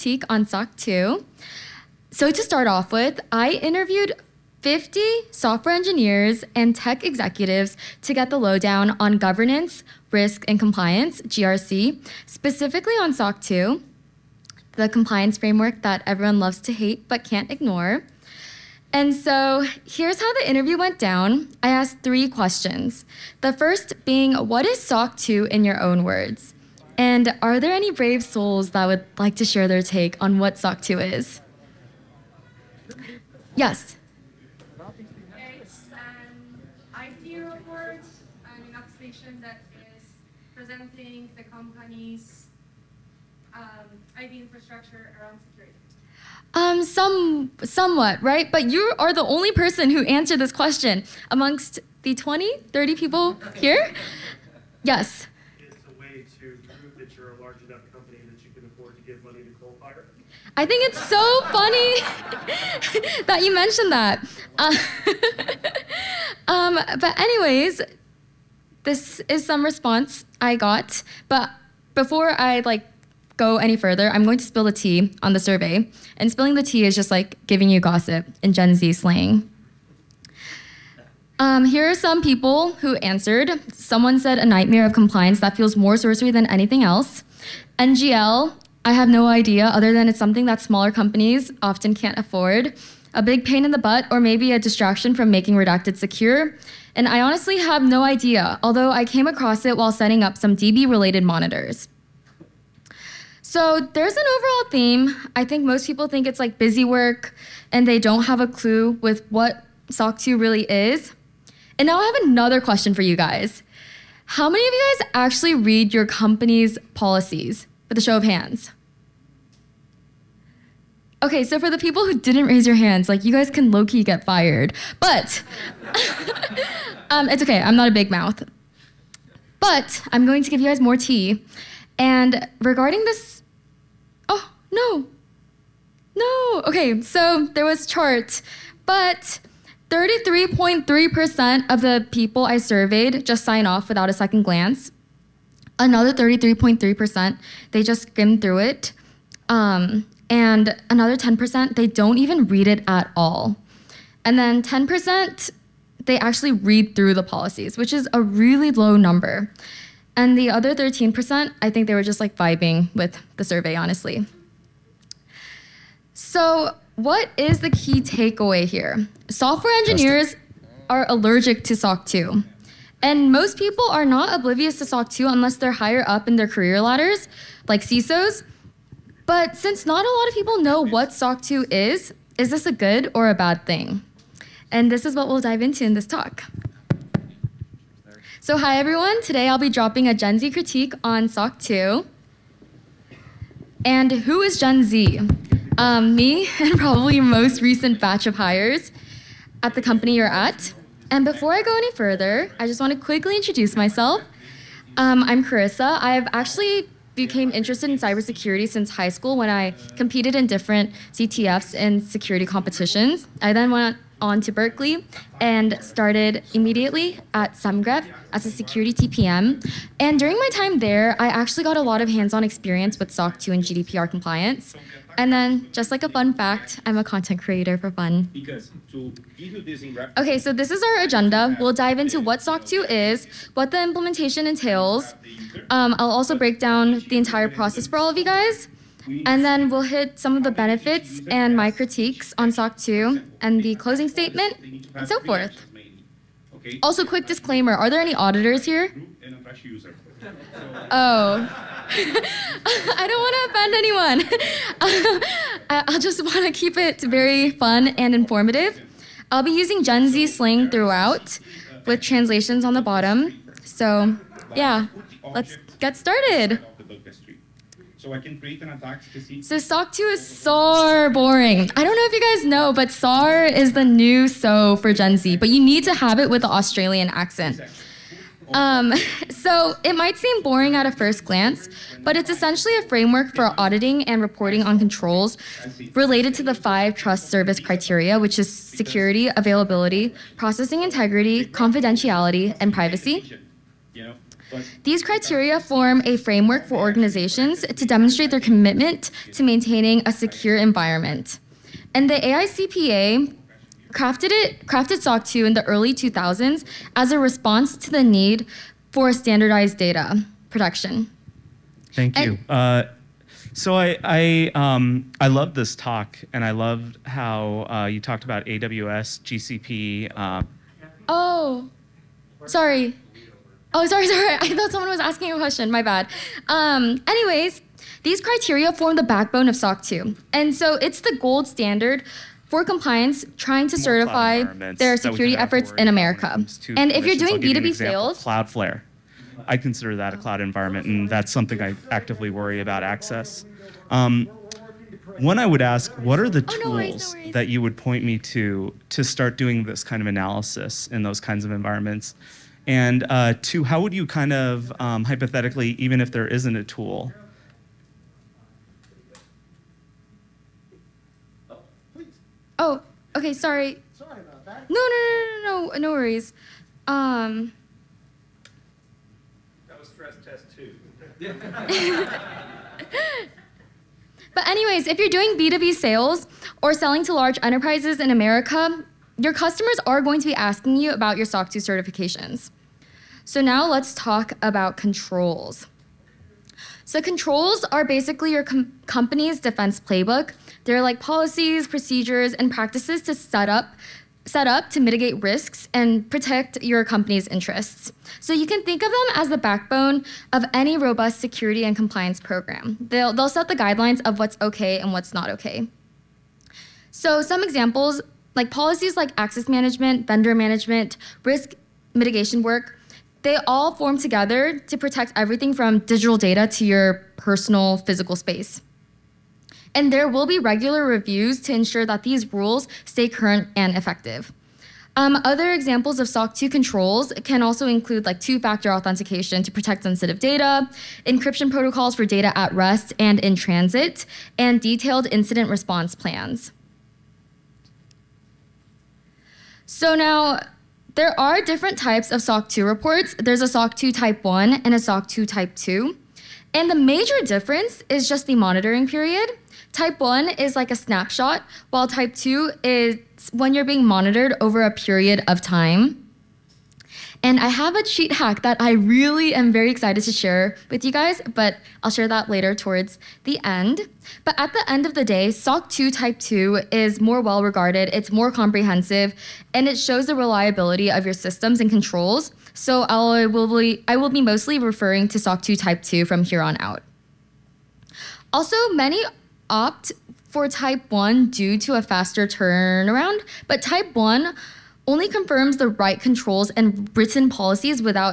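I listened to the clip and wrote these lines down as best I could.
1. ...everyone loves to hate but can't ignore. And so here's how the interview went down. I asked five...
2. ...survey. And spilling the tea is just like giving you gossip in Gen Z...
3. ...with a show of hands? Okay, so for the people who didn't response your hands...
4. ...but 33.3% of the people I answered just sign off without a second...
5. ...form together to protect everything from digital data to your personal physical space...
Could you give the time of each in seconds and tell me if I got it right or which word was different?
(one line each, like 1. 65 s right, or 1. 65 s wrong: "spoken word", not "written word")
1. 16 s wrong: "three", not "five"
2. 75 s right
3. 117 s wrong: "raise", not "response"
4. 138 s wrong: "surveyed", not "answered"
5. 413 s right.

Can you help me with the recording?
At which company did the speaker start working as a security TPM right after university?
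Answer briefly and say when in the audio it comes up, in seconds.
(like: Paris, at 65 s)
Semgrep, at 217 s.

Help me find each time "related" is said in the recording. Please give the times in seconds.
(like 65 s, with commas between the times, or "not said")
100 s, 285 s.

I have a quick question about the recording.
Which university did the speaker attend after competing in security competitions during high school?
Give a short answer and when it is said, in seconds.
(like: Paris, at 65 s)
Berkeley, at 214 s.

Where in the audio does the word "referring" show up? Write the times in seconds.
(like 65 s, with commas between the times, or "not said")
474 s.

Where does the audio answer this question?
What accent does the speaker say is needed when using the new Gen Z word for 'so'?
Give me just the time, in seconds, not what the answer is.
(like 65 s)
276 s.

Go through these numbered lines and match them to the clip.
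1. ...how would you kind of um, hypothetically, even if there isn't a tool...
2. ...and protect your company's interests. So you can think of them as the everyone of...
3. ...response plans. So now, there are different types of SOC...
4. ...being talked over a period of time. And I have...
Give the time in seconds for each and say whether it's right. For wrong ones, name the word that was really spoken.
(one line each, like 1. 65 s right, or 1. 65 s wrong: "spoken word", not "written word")
1. 353 s right
2. 395 s wrong: "backbone", not "everyone"
3. 435 s right
4. 453 s wrong: "monitored", not "talked".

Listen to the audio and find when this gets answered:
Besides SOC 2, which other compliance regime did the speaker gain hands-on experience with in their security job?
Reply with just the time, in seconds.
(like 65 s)
223 s.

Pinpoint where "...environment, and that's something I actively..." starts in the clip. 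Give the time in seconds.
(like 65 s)
340 s.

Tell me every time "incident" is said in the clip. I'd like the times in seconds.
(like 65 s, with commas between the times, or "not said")
435 s.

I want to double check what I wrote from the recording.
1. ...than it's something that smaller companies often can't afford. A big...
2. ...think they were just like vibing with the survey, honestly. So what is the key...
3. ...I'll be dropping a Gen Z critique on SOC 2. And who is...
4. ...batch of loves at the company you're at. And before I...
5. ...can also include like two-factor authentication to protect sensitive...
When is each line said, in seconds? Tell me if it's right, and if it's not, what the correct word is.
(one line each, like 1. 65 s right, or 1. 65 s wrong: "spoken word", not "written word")
1. 89 s right
2. 161 s right
3. 189 s right
4. 197 s wrong: "hires", not "loves"
5. 427 s right.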